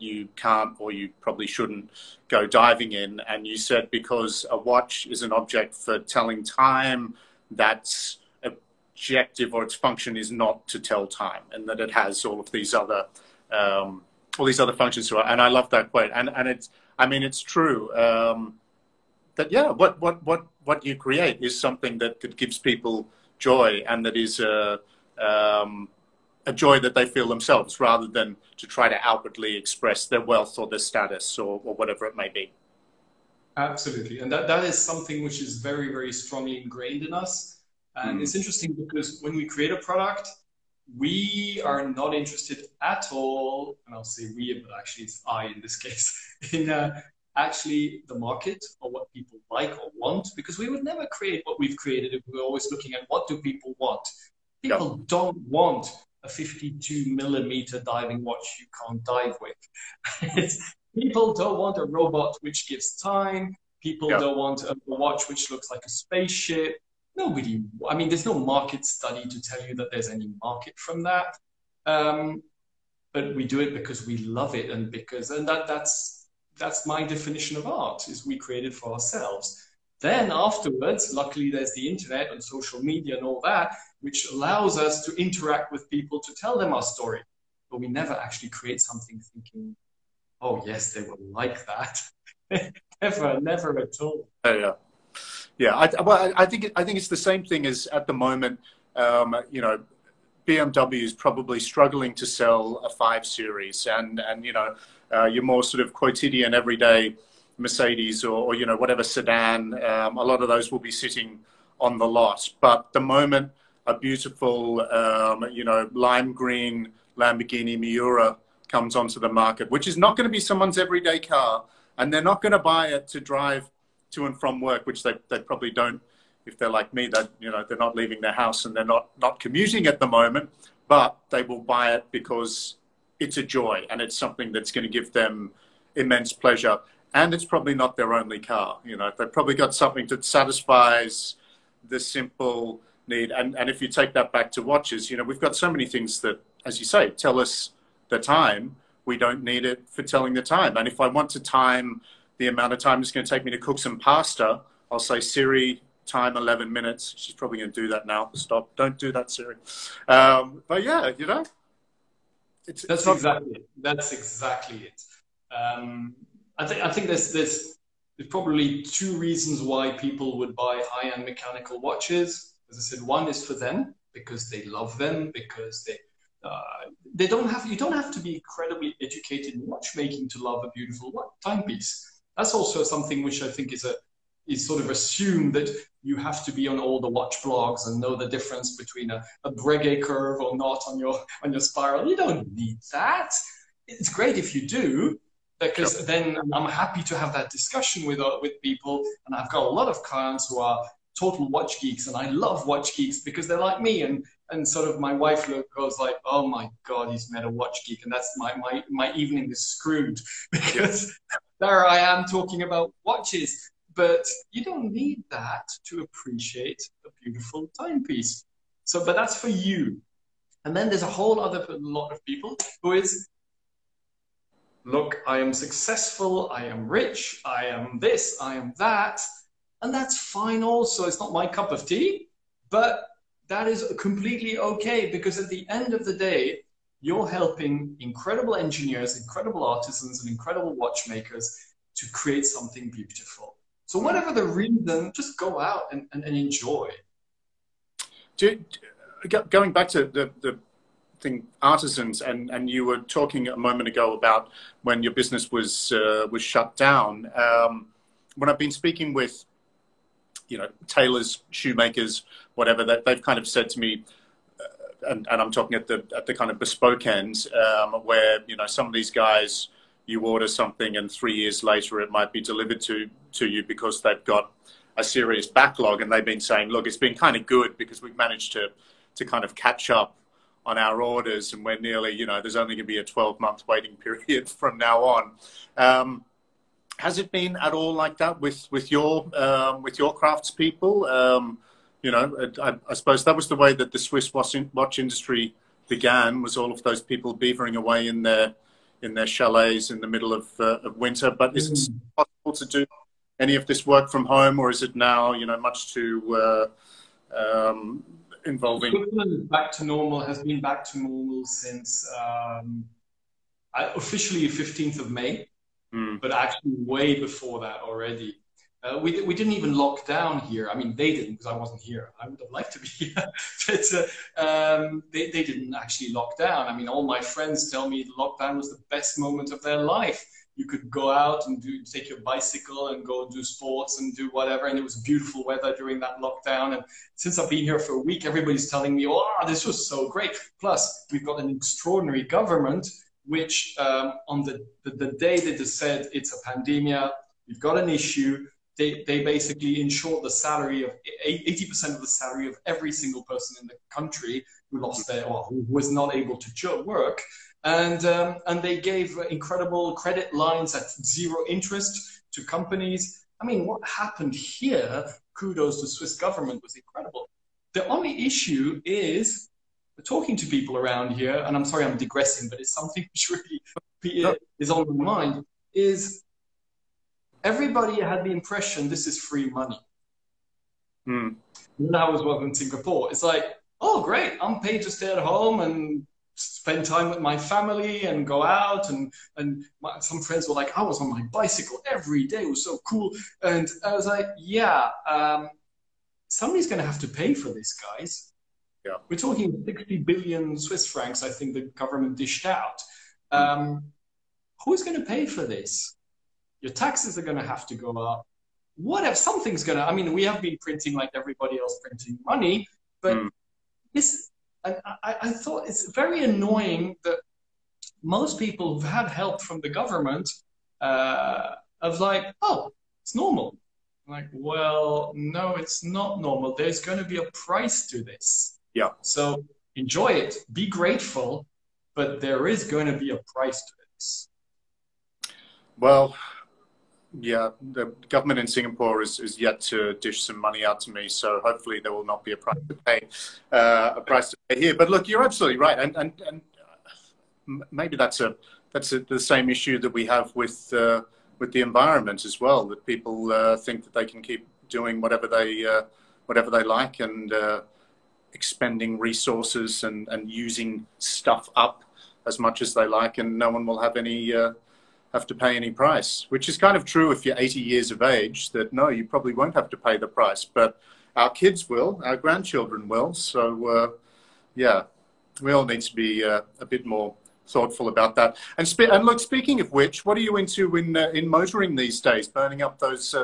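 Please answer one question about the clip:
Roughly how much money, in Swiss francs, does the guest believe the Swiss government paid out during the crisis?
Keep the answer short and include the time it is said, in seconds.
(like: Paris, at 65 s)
60 billion, at 399 s.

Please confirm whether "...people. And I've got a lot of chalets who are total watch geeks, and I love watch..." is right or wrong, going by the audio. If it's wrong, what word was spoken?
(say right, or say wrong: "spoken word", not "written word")
wrong: "clients", not "chalets".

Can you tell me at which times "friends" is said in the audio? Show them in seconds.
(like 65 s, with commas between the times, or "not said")
327 s, 390 s.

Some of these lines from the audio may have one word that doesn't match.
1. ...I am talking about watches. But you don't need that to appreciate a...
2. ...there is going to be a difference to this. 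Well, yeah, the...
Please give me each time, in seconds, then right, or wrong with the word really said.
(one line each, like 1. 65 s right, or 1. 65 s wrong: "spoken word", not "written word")
1. 211 s right
2. 432 s wrong: "price", not "difference".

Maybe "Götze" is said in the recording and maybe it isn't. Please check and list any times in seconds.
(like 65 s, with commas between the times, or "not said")
not said.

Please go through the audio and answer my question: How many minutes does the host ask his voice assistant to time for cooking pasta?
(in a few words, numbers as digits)
11.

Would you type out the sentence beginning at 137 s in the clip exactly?
And it's probably not their only car.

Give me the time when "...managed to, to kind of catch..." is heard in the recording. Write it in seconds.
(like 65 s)
278 s.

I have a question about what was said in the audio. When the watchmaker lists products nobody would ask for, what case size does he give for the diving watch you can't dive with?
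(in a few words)
52 millimeter.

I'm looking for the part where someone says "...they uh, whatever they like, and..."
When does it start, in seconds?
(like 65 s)
455 s.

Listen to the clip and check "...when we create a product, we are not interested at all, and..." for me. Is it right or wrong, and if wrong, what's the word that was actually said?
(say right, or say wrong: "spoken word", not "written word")
right.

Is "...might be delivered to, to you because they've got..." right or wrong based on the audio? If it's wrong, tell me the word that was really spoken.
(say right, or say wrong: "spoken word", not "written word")
right.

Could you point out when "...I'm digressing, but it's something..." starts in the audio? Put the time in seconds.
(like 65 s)
371 s.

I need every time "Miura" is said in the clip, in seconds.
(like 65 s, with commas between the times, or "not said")
117 s.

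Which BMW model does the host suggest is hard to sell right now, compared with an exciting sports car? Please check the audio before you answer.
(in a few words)
5 Series.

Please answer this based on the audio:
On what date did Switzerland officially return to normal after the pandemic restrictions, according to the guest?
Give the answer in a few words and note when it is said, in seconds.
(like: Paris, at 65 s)
15 May, at 314 s.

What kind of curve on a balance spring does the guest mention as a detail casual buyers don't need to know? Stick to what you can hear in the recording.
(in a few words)
Breguet curve.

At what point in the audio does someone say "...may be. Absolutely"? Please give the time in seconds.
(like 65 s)
32 s.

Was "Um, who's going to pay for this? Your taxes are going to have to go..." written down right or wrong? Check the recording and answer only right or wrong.
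right.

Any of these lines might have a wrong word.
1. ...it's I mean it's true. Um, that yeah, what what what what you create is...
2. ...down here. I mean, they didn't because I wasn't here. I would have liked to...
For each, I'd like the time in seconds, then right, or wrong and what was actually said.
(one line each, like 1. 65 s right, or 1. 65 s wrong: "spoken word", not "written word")
1. 16 s right
2. 320 s right.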